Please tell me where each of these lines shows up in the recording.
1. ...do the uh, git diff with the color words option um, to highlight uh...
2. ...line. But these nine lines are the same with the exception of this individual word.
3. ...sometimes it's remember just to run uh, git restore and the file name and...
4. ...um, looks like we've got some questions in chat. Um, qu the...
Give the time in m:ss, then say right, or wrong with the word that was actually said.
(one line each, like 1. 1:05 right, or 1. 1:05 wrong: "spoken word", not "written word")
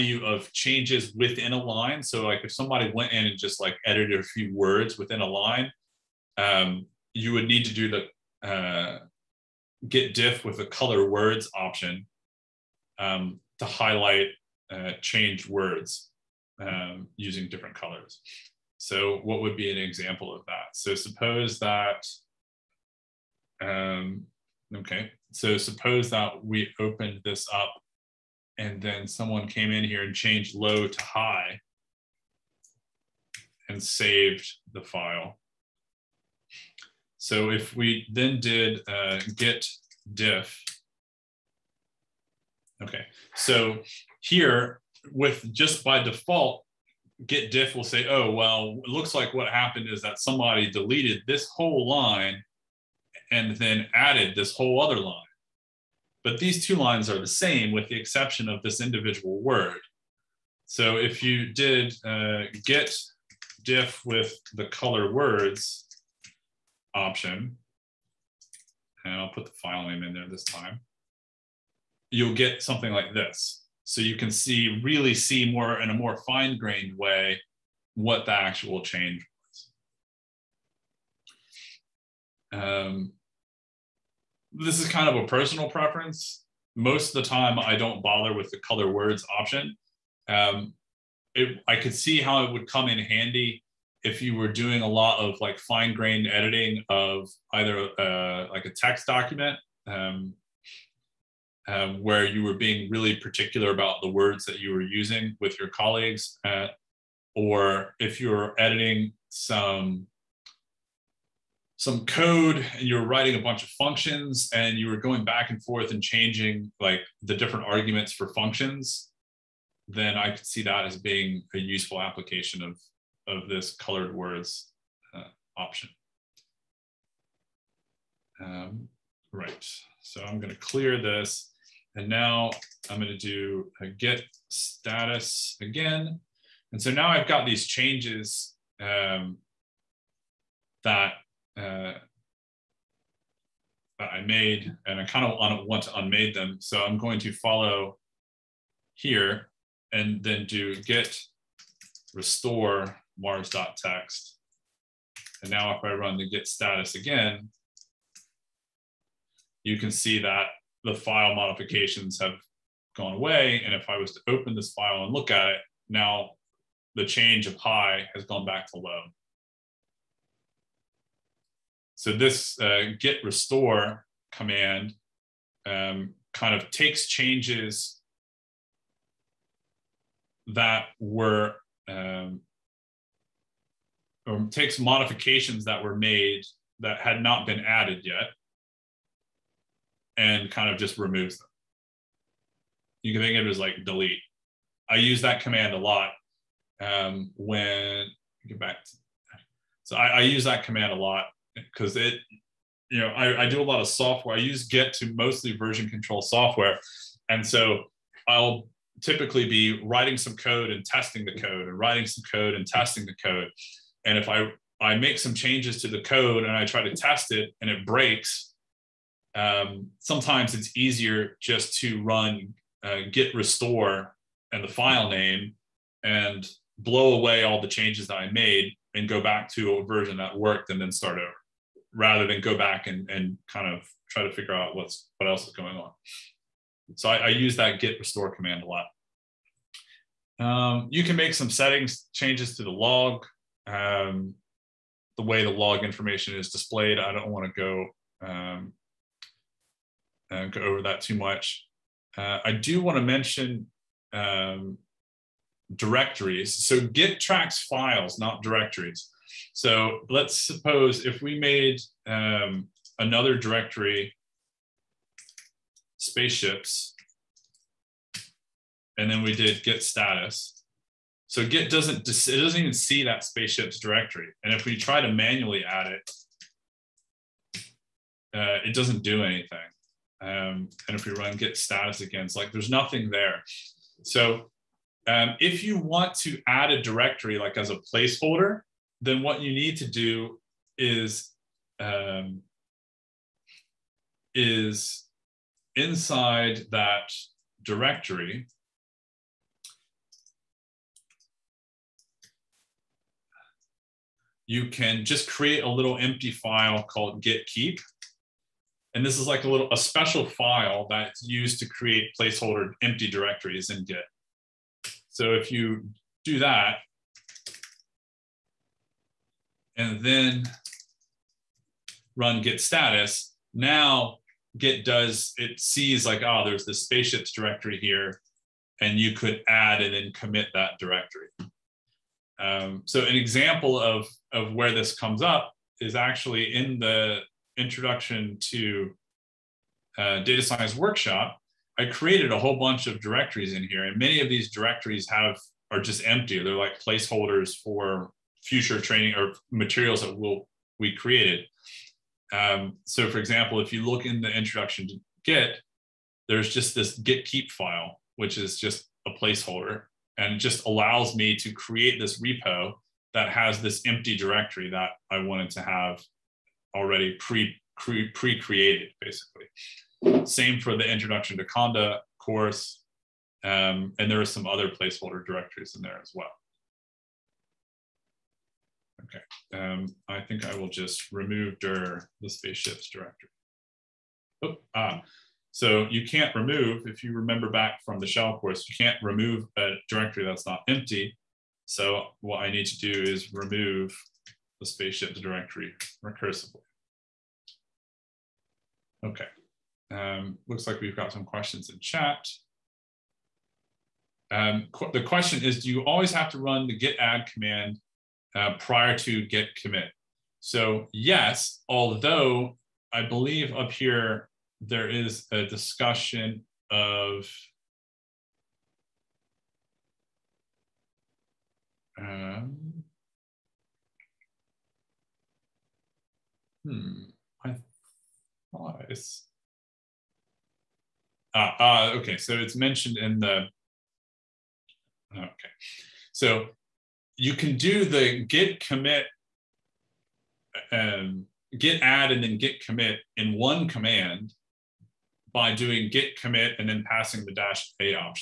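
1. 0:07 right
2. 0:55 wrong: "two", not "nine"
3. 3:39 wrong: "easier", not "remember"
4. 6:39 right.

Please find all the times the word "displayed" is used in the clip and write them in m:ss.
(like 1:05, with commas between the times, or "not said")
4:06.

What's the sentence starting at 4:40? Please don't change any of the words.
Um, and if we run git status again, it's like there's nothing there.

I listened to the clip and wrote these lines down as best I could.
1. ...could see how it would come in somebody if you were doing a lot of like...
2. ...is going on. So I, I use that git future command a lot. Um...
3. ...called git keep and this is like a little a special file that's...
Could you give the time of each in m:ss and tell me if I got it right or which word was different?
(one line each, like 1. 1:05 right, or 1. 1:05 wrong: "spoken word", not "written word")
1. 1:31 wrong: "handy", not "somebody"
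2. 3:55 wrong: "restore", not "future"
3. 5:06 right.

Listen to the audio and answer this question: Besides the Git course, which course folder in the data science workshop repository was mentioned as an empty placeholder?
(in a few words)
introduction to Conda.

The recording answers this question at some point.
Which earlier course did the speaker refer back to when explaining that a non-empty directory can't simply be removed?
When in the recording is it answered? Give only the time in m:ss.
6:28.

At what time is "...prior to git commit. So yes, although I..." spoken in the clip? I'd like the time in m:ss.
6:48.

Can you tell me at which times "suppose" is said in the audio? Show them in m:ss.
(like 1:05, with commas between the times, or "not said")
0:20, 0:25, 4:20.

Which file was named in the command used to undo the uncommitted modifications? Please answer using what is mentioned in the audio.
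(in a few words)
mars.txt.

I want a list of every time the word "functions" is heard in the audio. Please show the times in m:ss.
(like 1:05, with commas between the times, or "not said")
1:53, 1:58.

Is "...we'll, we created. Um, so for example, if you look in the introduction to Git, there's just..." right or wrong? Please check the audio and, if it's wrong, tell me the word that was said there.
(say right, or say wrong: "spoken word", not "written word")
right.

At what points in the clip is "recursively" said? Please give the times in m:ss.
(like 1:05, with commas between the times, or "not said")
6:36.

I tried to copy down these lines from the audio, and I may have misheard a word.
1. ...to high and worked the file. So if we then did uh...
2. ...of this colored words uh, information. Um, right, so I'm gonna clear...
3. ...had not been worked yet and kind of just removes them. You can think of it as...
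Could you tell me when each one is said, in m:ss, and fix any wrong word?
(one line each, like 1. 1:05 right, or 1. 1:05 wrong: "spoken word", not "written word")
1. 0:30 wrong: "saved", not "worked"
2. 2:03 wrong: "option", not "information"
3. 3:06 wrong: "added", not "worked".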